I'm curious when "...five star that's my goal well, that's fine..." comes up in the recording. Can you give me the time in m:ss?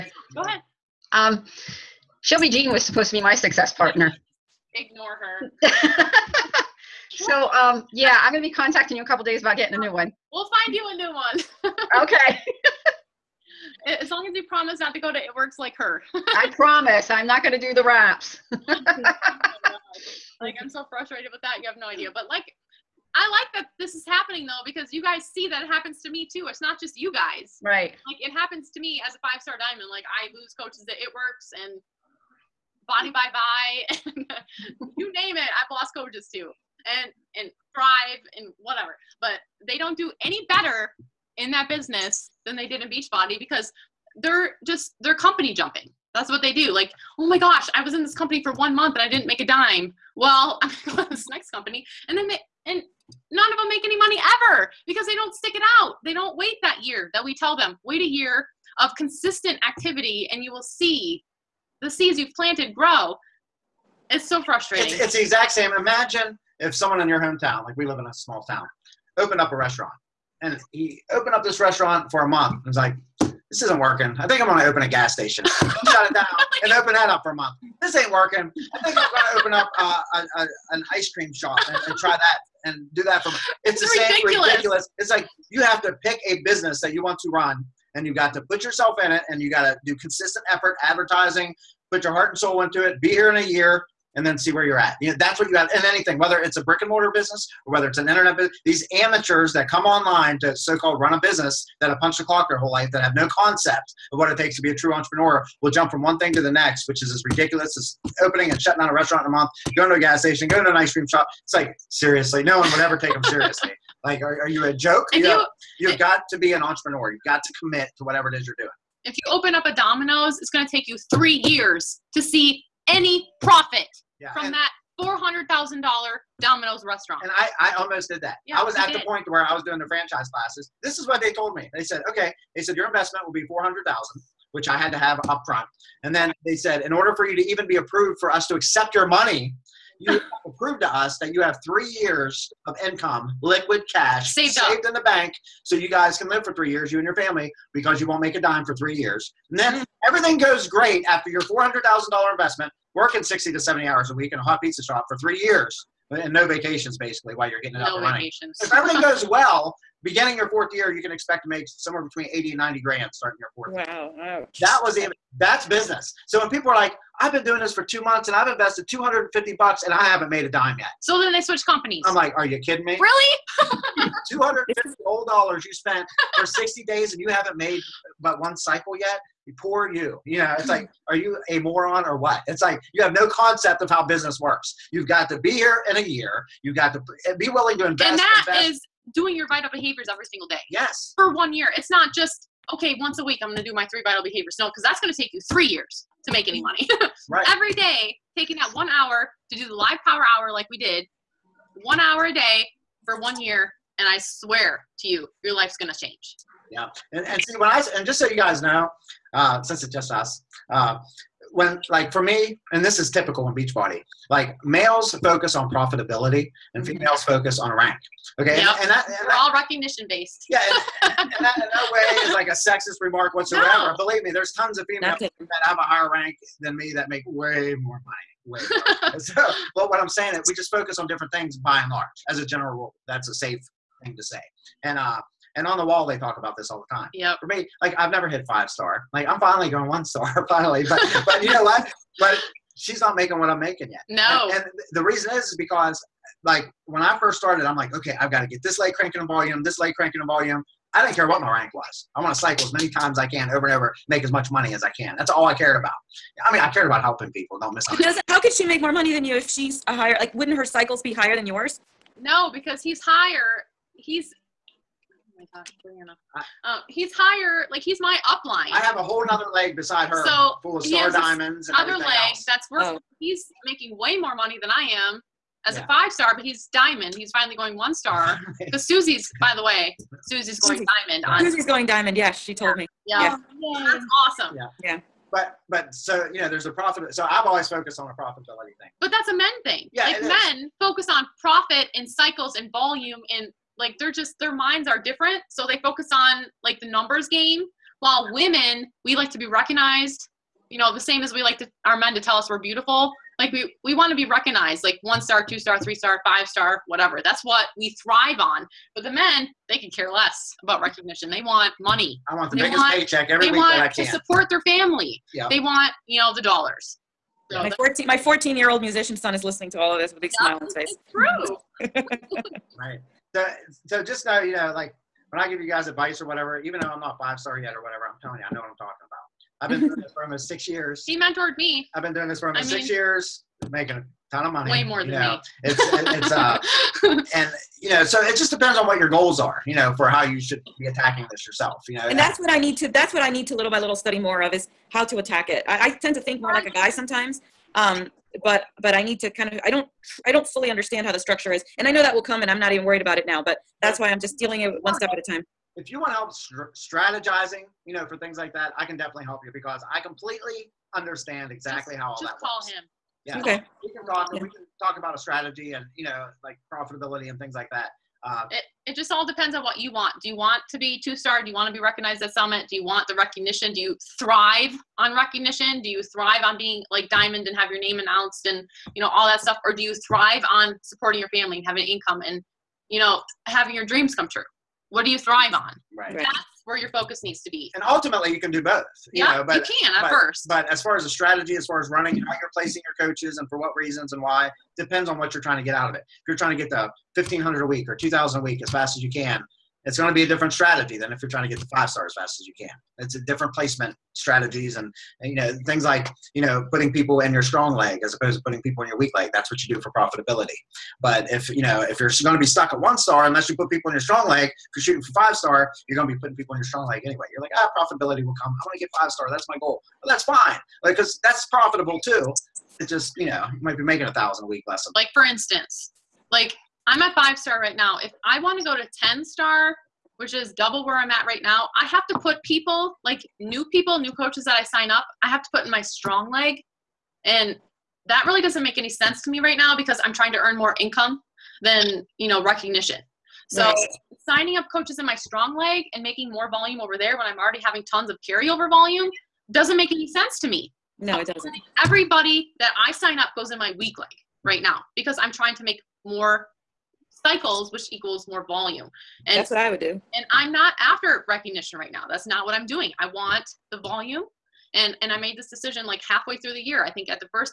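6:59.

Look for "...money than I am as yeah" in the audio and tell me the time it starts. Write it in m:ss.
4:34.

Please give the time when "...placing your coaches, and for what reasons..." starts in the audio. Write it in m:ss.
6:32.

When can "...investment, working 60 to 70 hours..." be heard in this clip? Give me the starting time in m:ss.
2:32.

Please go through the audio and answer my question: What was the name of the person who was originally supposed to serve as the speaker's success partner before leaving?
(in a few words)
Shelby Jean.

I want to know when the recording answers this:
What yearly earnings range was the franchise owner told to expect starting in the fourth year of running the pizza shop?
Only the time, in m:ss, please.
2:42.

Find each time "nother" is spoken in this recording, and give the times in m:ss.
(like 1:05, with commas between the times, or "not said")
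4:29.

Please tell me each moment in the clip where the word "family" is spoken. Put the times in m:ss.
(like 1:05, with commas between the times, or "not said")
2:27, 5:14, 6:21.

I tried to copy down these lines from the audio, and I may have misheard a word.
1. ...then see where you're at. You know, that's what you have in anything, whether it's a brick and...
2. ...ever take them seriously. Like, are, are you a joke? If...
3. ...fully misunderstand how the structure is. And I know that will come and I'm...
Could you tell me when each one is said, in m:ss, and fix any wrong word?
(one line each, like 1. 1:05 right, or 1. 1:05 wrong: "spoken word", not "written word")
1. 1:34 right
2. 1:52 right
3. 5:50 wrong: "understand", not "misunderstand".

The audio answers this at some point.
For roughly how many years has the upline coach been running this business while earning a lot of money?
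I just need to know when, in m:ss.
5:30.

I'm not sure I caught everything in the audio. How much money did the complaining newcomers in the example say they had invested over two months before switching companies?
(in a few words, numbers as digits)
250 bucks.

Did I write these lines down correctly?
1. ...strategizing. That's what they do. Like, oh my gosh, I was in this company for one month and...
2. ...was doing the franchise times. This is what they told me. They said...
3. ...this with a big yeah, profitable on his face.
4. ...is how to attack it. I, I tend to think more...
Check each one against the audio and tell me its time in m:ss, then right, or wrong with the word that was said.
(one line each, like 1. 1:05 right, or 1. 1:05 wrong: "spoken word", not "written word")
1. 0:45 wrong: "jumping", not "strategizing"
2. 2:09 wrong: "classes", not "times"
3. 5:19 wrong: "smile", not "profitable"
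4. 5:44 right.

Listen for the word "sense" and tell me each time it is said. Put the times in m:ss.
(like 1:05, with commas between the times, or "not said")
7:18, 7:30.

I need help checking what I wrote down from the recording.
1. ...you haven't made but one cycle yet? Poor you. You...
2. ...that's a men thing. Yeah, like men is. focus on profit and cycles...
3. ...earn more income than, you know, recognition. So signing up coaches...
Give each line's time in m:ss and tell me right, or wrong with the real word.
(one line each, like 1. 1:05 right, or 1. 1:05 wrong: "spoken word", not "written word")
1. 2:57 right
2. 4:49 right
3. 7:20 right.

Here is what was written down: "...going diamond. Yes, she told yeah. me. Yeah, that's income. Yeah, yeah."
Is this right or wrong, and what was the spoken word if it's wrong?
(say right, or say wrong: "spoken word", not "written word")
wrong: "awesome", not "income".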